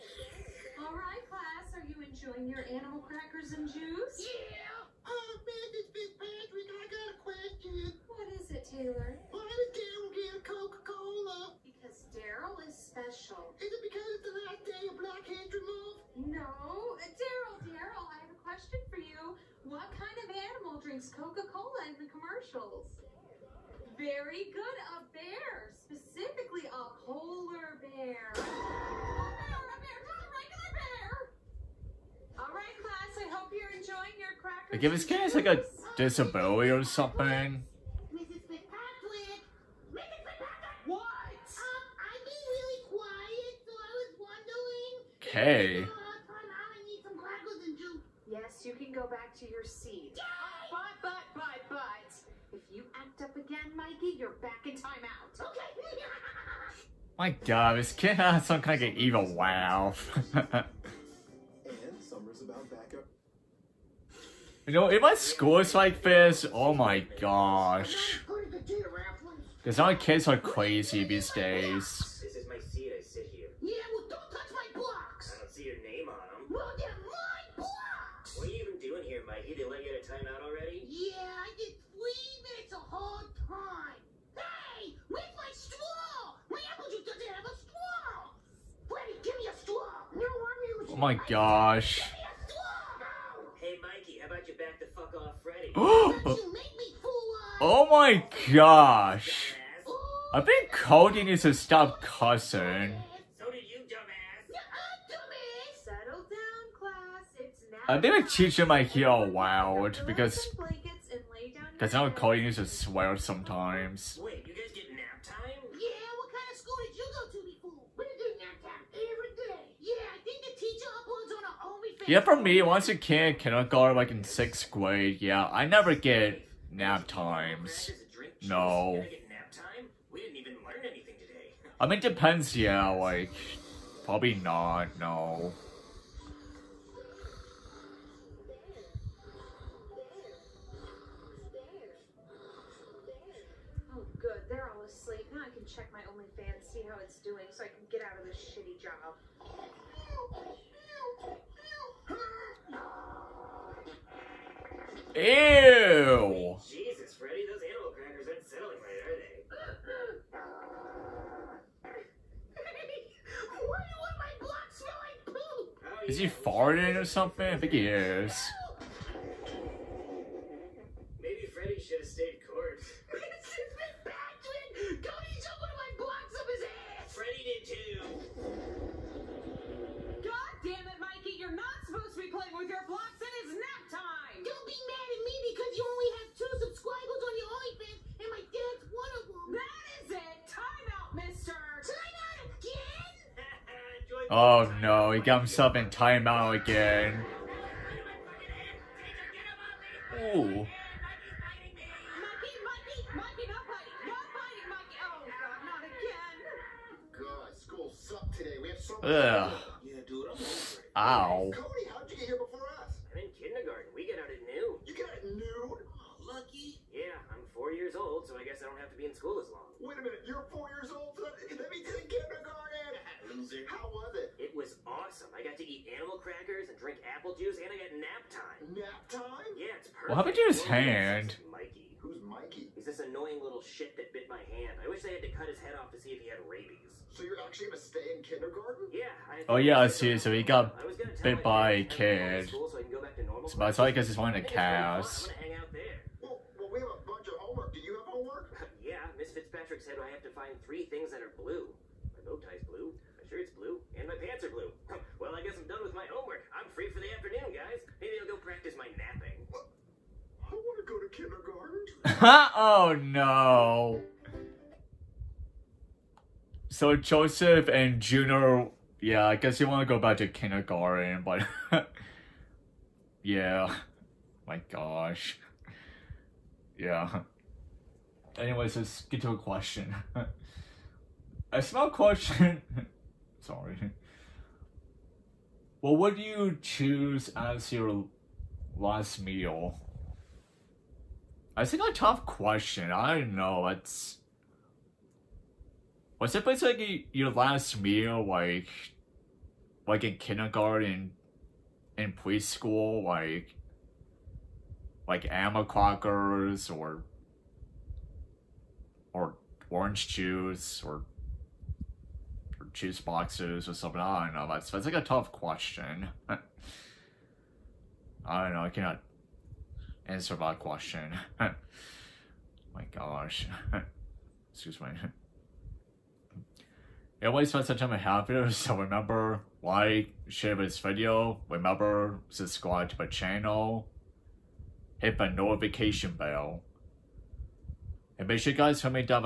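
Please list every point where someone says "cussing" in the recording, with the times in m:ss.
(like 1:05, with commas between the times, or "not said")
1:42.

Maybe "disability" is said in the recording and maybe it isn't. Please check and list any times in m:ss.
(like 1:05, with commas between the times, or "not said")
0:35.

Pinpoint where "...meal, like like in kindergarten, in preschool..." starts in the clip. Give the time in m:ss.
4:57.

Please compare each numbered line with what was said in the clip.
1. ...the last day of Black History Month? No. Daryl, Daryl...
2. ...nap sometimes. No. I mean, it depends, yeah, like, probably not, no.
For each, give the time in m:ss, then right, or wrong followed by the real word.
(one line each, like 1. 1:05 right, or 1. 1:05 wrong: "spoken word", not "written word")
1. 0:14 right
2. 2:06 wrong: "times", not "sometimes".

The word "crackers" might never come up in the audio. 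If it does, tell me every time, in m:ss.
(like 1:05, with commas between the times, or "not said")
0:03, 0:34, 2:37, 3:46, 5:05.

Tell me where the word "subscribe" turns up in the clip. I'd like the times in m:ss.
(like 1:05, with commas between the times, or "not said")
5:32.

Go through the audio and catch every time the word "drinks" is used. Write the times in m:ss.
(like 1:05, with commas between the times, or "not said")
0:20, 3:46.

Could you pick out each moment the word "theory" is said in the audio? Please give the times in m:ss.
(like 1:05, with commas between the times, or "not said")
not said.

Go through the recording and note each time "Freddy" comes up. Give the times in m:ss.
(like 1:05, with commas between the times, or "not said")
1:35, 2:37.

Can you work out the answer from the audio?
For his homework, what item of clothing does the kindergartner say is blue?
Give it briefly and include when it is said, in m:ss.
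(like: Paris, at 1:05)
Bow tie, at 4:12.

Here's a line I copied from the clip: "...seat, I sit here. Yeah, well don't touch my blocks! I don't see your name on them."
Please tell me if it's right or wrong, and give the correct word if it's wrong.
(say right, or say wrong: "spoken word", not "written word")
right.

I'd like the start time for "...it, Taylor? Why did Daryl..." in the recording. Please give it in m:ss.
0:08.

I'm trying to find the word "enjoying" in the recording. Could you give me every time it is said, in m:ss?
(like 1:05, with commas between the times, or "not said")
0:01, 0:33.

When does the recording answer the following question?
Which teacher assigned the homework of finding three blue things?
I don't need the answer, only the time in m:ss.
4:09.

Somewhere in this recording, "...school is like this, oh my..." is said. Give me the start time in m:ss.
1:05.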